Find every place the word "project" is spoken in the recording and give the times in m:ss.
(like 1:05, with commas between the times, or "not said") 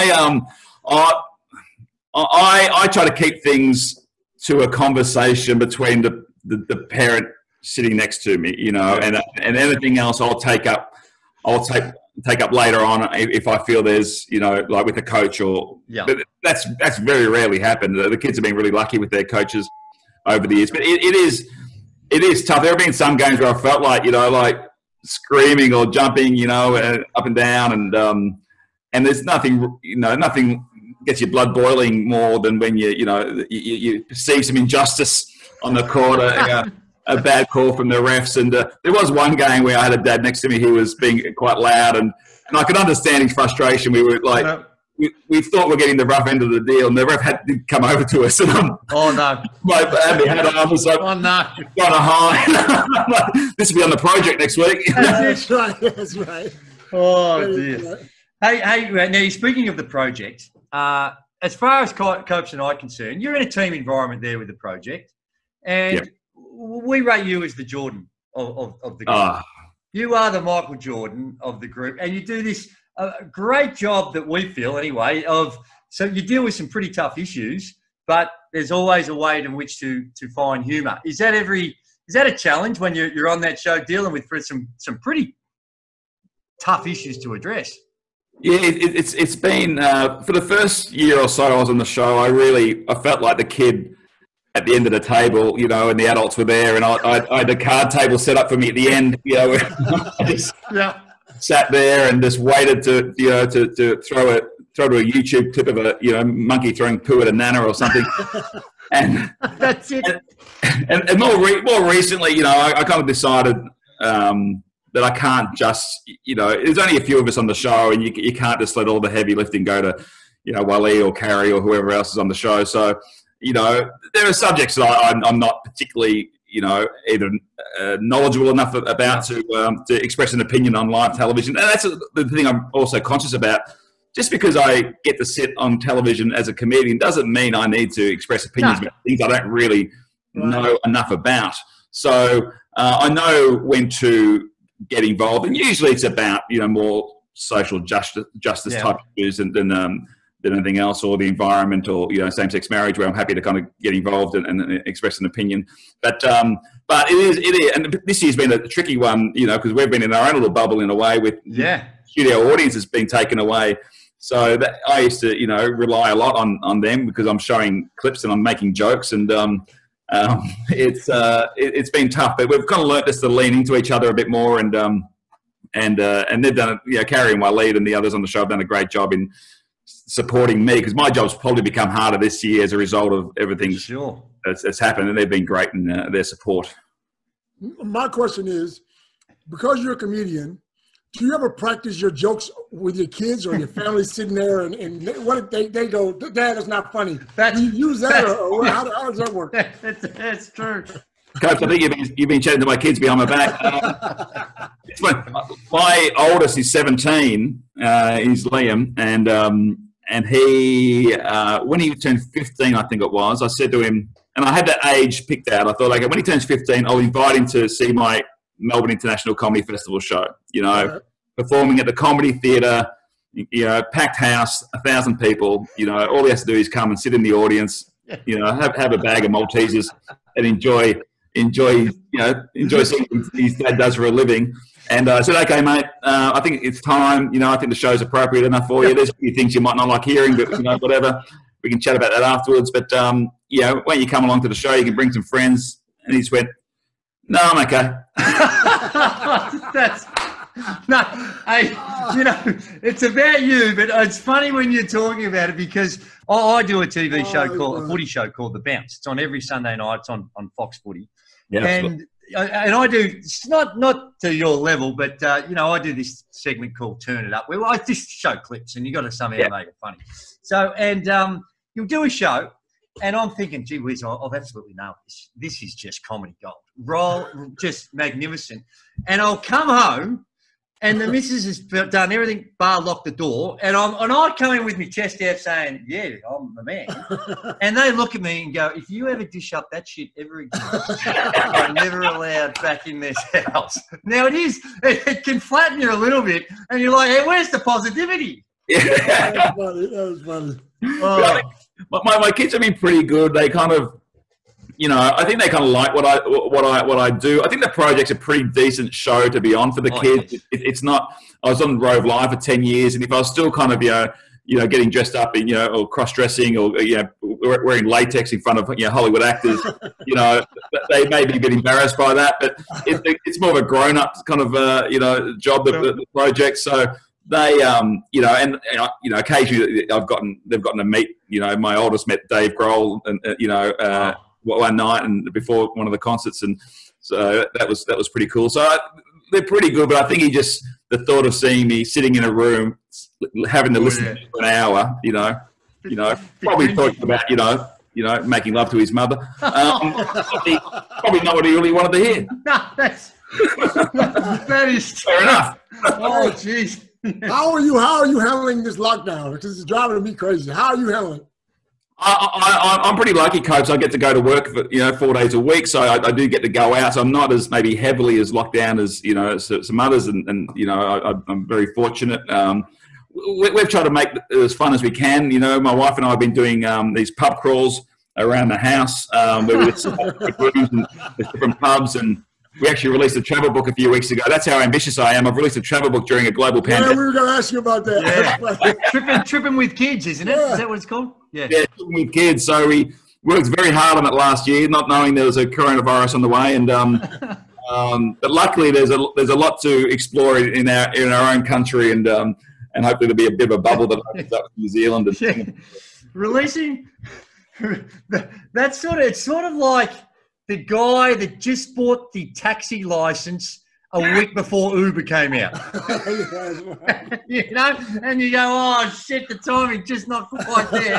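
0:53, 0:59, 1:04, 5:07, 5:26.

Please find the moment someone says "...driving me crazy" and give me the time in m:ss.
5:59.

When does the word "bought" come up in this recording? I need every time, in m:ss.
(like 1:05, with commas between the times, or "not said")
6:51.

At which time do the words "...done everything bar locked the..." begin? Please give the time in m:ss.
4:41.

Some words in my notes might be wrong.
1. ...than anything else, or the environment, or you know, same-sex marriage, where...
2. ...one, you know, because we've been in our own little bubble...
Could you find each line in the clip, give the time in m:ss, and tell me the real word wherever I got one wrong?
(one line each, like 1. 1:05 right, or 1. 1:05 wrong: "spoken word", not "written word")
1. 2:30 right
2. 2:38 right.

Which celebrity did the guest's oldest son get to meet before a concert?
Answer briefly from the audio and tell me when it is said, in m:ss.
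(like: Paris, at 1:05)
Dave Grohl, at 5:32.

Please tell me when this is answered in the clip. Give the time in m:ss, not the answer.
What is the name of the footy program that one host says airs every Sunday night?
4:18.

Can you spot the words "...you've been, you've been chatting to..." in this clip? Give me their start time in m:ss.
3:21.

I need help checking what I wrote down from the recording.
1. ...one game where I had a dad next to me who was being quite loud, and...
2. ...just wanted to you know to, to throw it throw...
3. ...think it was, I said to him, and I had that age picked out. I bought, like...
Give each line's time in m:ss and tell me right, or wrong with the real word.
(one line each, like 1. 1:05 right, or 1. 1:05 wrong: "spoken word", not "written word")
1. 0:39 right
2. 1:42 wrong: "waited", not "wanted"
3. 3:32 wrong: "thought", not "bought".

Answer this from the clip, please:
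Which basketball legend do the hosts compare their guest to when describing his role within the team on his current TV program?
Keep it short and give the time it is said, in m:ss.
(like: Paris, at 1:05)
Michael Jordan, at 1:10.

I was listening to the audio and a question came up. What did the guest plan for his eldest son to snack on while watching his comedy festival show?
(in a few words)
Maltesers.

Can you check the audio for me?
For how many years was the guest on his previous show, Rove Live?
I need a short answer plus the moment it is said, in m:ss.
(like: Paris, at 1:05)
10, at 5:12.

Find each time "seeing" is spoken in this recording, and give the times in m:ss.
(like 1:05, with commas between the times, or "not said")
3:52, 5:41.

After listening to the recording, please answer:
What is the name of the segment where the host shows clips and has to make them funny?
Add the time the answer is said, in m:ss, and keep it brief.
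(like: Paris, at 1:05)
Turn It Up, at 4:27.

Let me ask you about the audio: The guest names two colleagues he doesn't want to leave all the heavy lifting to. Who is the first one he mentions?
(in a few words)
Wally.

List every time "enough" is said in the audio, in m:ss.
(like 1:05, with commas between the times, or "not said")
2:08, 2:20, 3:58, 5:55.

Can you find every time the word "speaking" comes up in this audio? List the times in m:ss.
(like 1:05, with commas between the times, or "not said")
0:59.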